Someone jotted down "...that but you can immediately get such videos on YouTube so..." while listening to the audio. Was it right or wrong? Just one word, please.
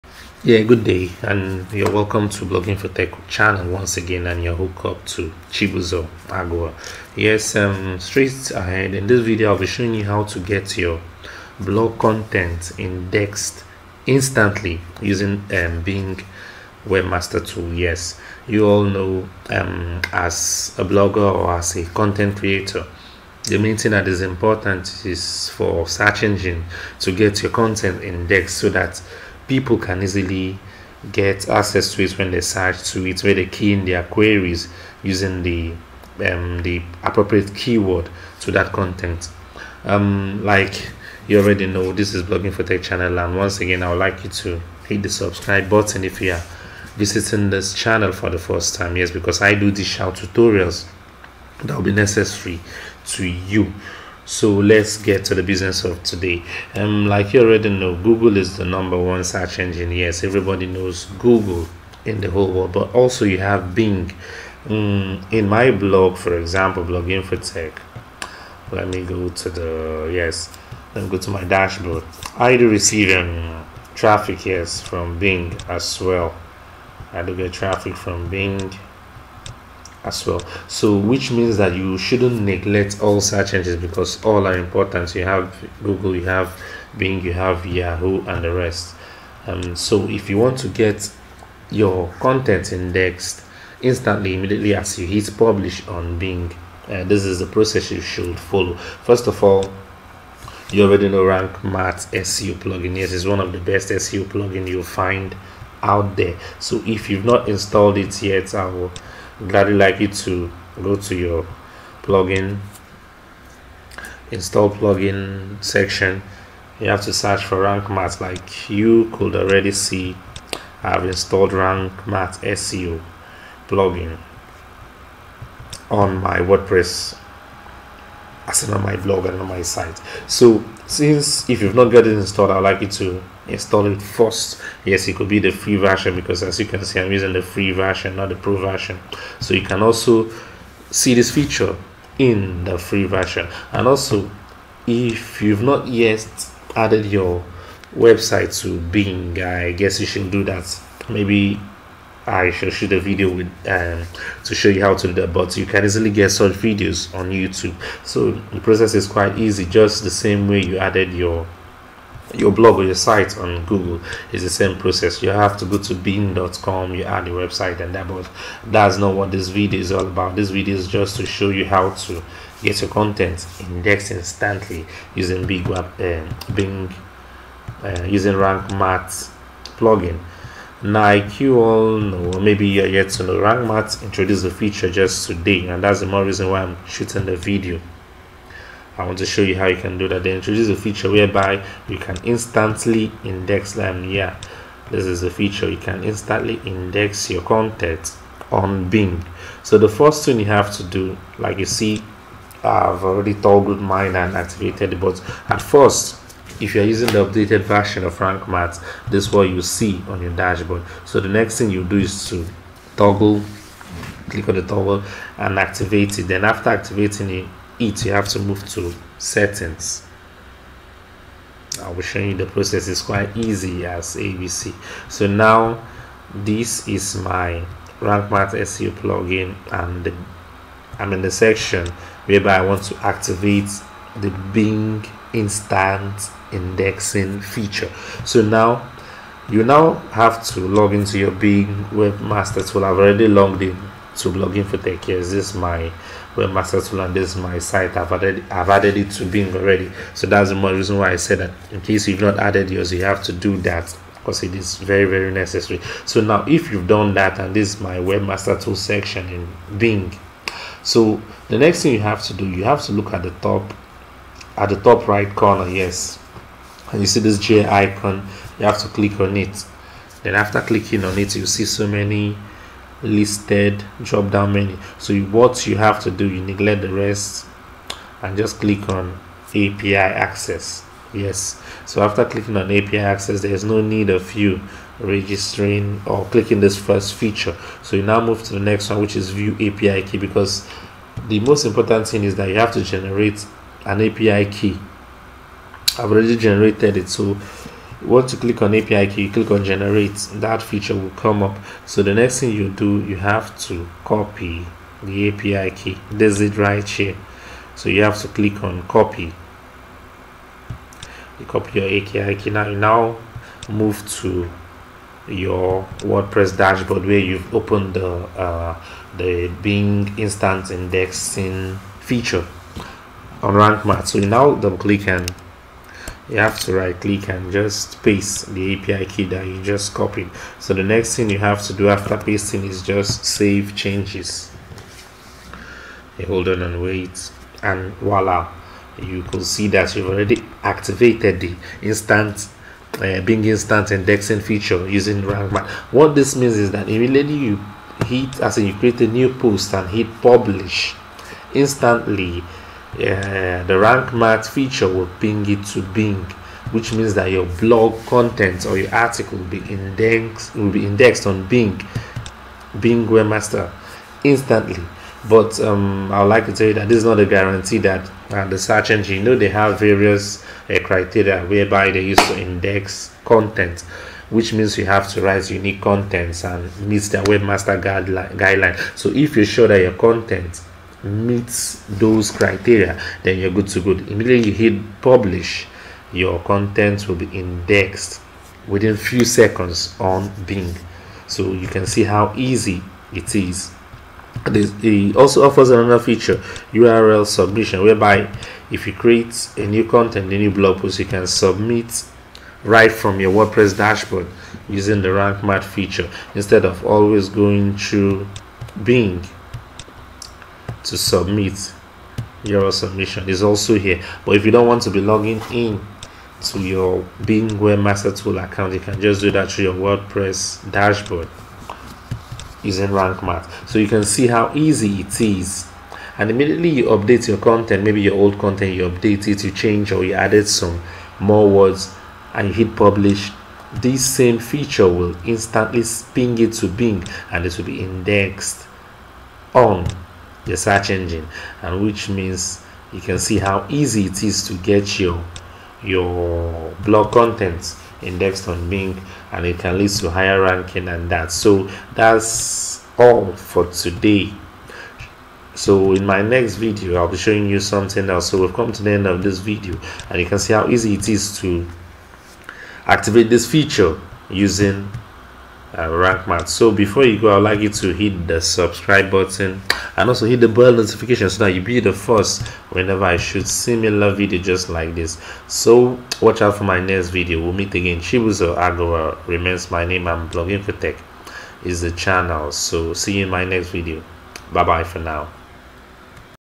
wrong.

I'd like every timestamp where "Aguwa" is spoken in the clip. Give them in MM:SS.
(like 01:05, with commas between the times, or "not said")
00:06, 07:58.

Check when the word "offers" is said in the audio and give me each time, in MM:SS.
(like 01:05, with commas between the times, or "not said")
06:35.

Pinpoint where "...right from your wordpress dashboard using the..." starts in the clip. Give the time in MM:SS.
06:42.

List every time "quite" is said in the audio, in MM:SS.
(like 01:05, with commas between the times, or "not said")
02:39, 03:43.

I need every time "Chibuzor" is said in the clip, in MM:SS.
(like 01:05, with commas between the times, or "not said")
00:05, 07:57.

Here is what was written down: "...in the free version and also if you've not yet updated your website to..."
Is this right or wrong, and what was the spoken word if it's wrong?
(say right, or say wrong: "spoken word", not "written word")
wrong: "added", not "updated".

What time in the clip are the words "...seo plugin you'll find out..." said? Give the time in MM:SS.
01:43.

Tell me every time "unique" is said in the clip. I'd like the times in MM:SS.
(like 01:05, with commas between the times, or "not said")
06:15.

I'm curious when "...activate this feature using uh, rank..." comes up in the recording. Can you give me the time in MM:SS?
07:42.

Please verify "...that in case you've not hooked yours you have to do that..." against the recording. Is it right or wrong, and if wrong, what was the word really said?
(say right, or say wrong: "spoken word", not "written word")
wrong: "added", not "hooked".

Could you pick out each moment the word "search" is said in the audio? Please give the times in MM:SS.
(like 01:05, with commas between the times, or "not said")
00:25, 00:32, 00:59, 01:23, 01:57, 06:08, 07:20.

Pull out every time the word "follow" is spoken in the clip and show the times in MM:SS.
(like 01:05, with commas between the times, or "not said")
01:38.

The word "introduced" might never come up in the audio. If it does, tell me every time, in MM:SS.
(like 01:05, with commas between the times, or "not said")
03:04, 03:10.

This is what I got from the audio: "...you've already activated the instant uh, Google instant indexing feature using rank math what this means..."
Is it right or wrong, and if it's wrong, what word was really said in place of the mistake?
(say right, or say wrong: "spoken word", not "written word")
wrong: "Bing", not "Google".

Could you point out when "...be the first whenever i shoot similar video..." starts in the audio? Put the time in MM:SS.
07:51.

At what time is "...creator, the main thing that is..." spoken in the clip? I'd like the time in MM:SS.
00:22.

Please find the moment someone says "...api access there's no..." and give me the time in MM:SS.
04:42.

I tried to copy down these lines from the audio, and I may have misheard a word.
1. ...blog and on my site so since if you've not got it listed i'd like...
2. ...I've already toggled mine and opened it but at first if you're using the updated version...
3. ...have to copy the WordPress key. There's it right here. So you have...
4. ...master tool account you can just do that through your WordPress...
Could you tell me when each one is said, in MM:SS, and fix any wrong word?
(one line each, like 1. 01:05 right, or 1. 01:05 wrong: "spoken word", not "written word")
1. 02:08 wrong: "installed", not "listed"
2. 03:22 wrong: "activated", not "opened"
3. 05:03 wrong: "API", not "WordPress"
4. 06:57 right.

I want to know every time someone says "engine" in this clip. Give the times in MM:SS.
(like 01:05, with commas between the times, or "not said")
00:26, 00:59, 01:23, 06:08, 07:20.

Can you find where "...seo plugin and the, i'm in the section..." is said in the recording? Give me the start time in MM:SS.
03:48.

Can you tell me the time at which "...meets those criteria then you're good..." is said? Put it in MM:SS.
06:21.